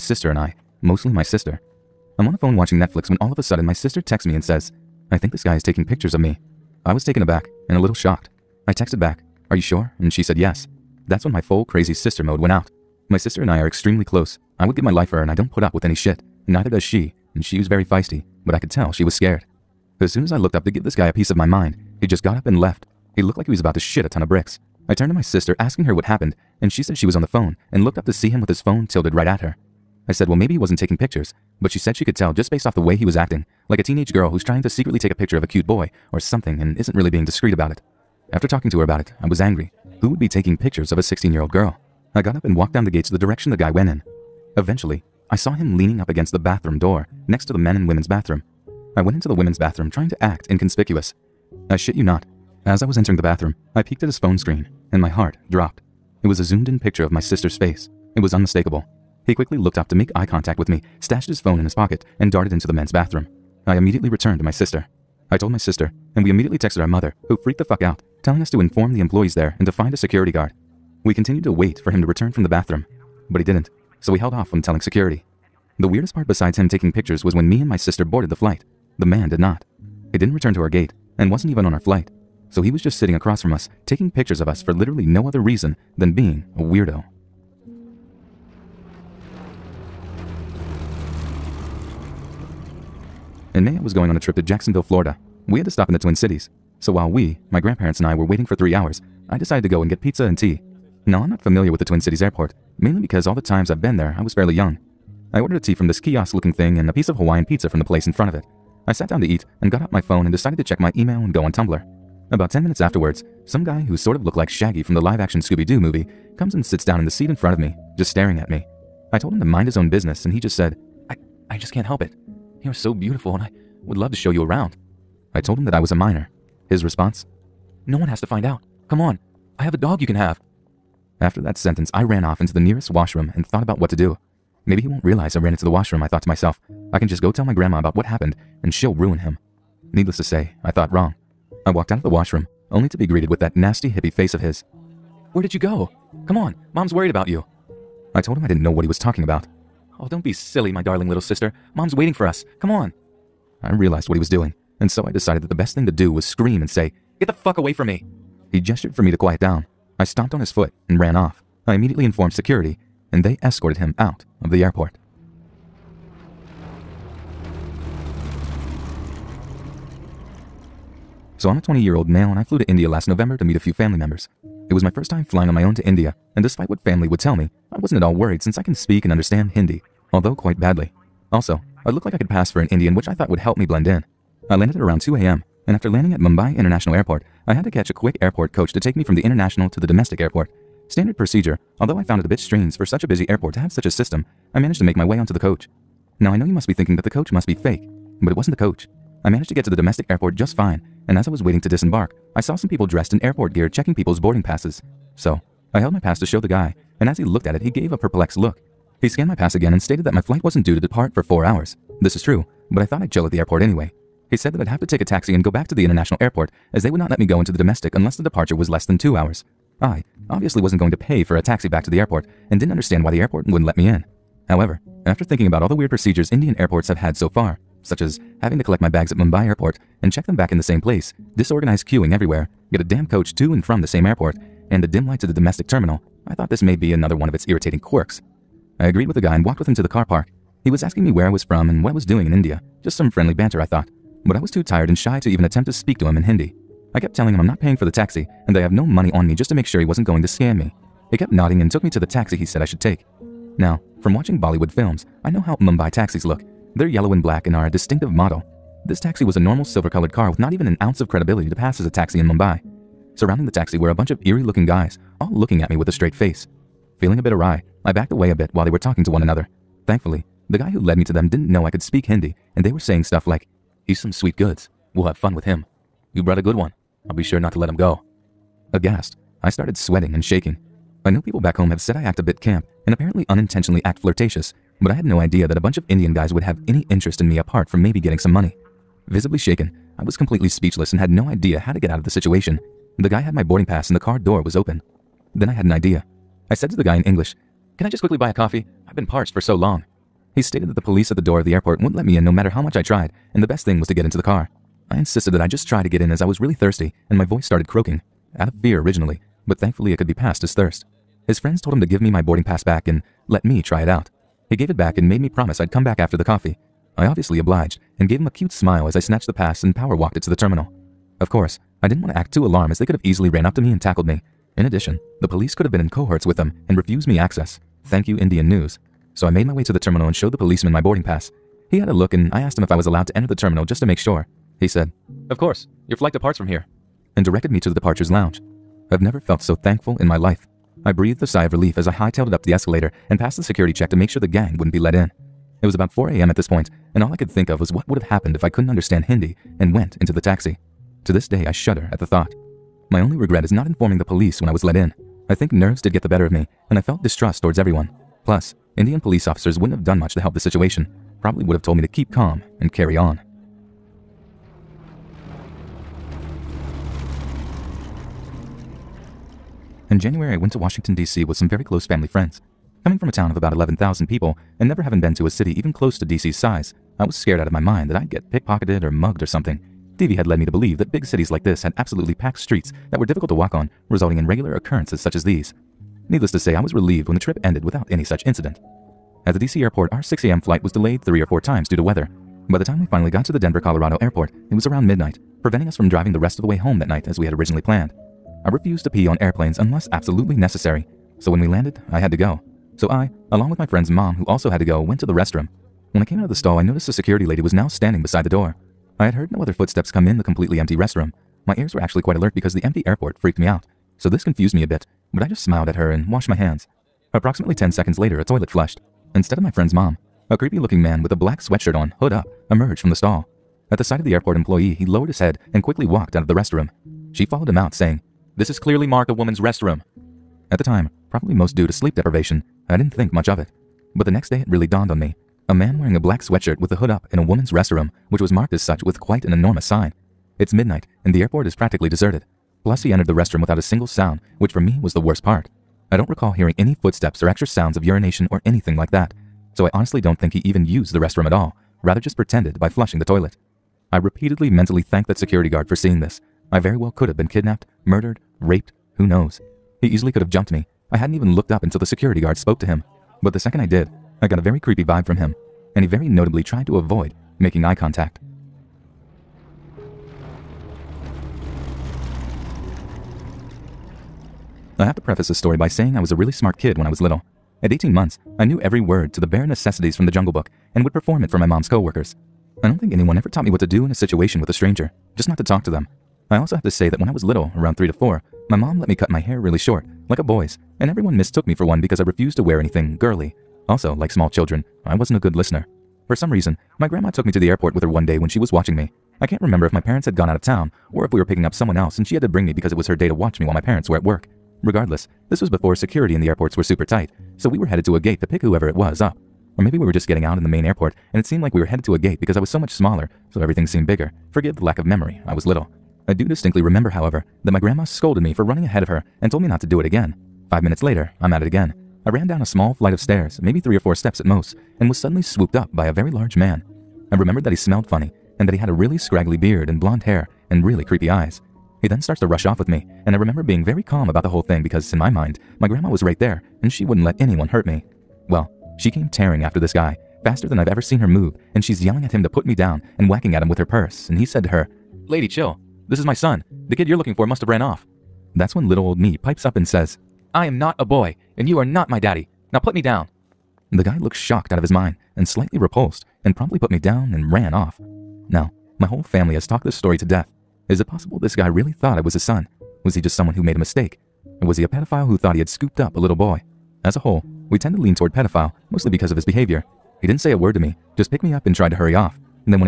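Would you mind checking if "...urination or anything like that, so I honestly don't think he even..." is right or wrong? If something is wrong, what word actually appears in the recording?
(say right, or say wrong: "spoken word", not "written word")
right.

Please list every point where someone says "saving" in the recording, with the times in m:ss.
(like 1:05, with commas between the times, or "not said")
not said.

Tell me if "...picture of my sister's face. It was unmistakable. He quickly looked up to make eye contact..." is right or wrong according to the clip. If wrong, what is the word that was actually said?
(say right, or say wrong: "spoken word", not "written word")
right.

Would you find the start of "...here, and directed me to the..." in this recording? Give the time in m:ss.
5:36.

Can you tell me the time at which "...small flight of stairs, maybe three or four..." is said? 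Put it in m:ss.
8:42.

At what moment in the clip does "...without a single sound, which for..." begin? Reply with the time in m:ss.
7:23.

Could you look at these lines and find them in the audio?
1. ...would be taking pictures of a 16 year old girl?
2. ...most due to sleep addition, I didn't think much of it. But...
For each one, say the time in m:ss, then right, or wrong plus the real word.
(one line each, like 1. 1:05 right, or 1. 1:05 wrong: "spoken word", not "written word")
1. 0:40 right
2. 7:11 wrong: "deprivation", not "addition".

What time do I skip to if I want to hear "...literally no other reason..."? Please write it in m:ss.
1:24.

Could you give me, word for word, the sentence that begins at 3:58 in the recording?
I agreed with the guy and walked with him to the car park.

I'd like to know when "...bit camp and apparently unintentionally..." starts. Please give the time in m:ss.
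4:42.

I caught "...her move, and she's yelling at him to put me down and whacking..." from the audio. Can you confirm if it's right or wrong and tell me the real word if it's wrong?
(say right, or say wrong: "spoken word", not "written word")
right.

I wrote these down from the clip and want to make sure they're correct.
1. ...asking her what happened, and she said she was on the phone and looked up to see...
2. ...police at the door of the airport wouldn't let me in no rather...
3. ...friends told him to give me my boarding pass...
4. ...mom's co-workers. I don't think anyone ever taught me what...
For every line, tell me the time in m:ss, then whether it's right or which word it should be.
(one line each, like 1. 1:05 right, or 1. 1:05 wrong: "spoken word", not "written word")
1. 0:25 right
2. 5:00 wrong: "matter", not "rather"
3. 5:11 right
4. 8:01 right.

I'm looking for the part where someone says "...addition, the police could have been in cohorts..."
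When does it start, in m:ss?
5:24.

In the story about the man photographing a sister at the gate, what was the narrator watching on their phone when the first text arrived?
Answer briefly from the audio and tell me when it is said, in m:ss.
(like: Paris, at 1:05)
Netflix, at 0:02.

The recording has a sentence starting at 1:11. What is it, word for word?
We continued to wait for him to return from the bathroom, but he didn't, so we held off from telling security.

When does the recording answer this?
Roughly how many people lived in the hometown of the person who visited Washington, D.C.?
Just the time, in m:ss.
6:13.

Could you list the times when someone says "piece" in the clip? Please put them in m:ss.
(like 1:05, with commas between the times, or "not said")
0:21, 1:46.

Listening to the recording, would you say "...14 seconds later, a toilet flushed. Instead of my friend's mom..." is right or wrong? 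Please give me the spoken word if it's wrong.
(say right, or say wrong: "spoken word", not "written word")
wrong: "10", not "14".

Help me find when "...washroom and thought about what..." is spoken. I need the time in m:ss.
2:12.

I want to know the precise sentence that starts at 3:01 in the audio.
Also, I looked like I could pass for an Indian, which I thought would help me blend in.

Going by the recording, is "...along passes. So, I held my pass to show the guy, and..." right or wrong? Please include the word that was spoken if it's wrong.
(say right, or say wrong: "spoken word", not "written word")
wrong: "boarding", not "along".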